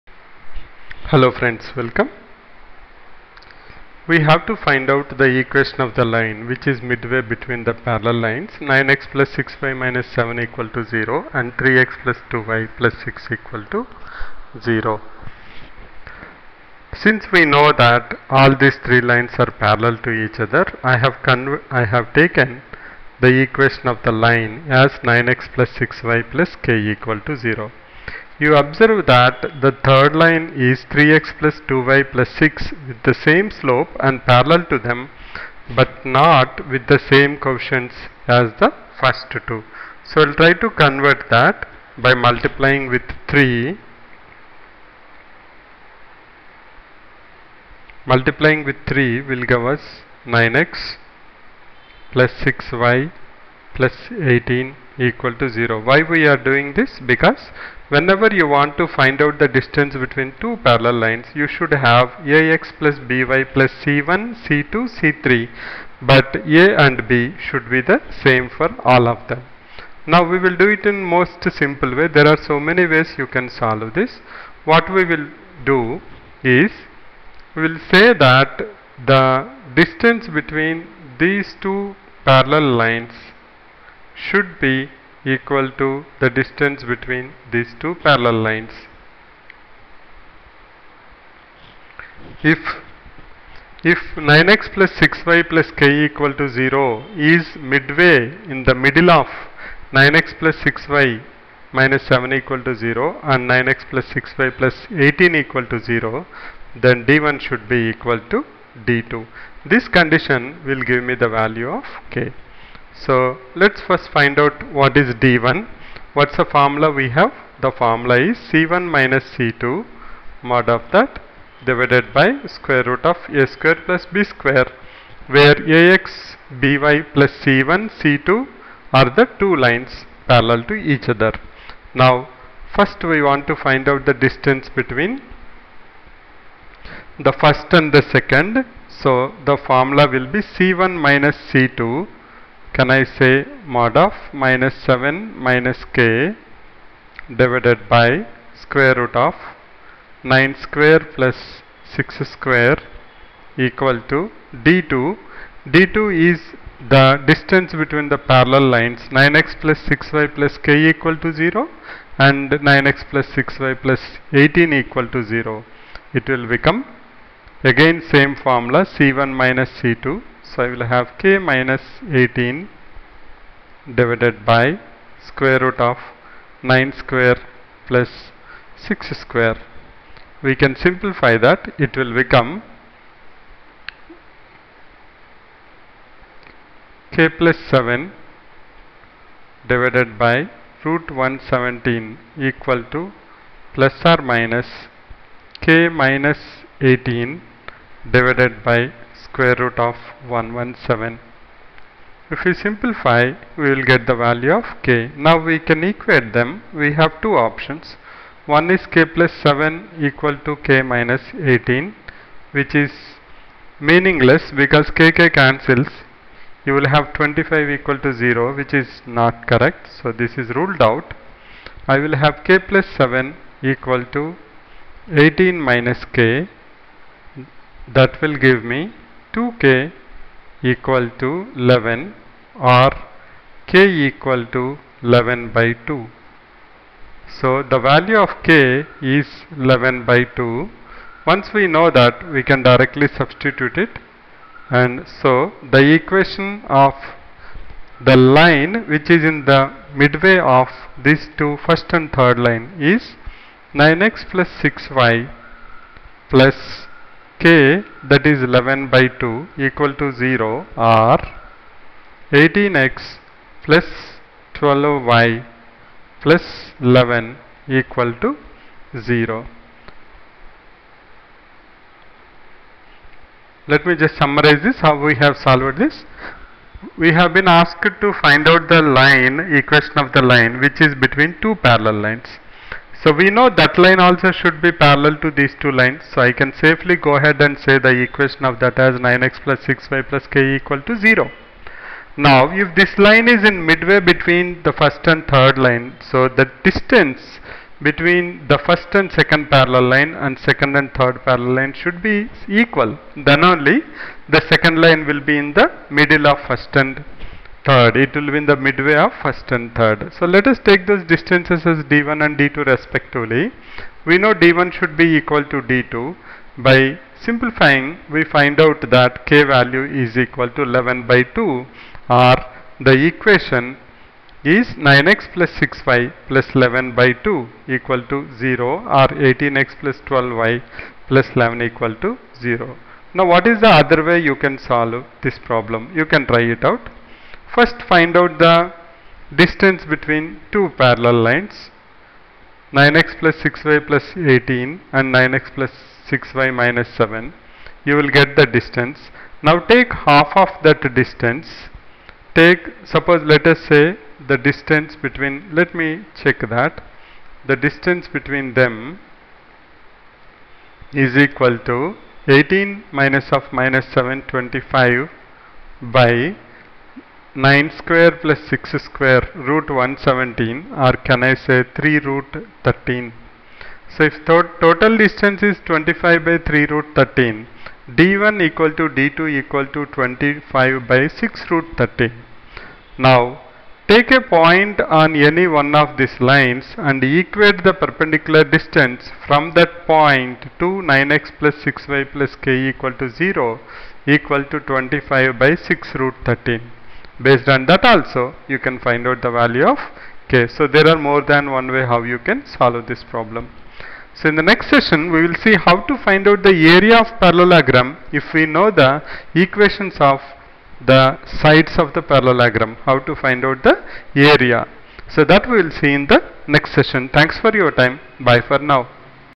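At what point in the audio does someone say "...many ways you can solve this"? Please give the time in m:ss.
1:12.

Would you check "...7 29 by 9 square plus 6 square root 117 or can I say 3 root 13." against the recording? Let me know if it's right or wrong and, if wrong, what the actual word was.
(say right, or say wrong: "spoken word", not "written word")
wrong: "25", not "29".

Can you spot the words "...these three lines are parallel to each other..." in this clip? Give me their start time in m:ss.
0:18.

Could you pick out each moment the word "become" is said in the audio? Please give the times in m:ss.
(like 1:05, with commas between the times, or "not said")
2:46, 3:02.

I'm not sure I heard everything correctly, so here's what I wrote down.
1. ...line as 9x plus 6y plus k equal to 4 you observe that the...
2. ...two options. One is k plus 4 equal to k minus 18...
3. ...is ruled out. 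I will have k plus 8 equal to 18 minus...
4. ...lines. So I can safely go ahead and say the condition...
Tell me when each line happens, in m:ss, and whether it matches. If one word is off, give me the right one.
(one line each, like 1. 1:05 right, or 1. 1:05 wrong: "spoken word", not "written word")
1. 0:24 wrong: "0", not "4"
2. 3:27 wrong: "7", not "4"
3. 3:40 wrong: "7", not "8"
4. 4:45 wrong: "equation", not "condition".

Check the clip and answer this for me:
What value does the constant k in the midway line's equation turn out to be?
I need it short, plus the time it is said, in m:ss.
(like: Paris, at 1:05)
11/2, at 3:53.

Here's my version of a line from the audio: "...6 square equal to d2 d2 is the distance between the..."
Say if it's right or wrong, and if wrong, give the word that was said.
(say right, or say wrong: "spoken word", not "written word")
right.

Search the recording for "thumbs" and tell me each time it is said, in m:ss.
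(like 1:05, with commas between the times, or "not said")
not said.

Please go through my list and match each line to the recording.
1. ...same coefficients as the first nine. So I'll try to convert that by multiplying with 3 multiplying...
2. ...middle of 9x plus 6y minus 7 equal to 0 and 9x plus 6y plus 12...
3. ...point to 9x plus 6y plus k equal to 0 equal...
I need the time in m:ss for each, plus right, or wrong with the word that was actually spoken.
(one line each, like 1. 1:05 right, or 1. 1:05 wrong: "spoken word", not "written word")
1. 0:37 wrong: "two", not "nine"
2. 1:38 wrong: "18", not "12"
3. 6:29 right.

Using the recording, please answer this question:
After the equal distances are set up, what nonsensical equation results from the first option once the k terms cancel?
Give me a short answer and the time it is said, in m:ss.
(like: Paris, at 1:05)
25 = 0, at 3:37.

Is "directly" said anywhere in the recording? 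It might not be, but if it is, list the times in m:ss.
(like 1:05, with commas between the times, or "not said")
4:02.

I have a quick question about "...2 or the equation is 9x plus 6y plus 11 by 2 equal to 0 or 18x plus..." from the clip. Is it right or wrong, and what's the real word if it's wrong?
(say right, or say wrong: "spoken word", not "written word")
right.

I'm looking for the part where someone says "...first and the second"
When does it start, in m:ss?
2:17.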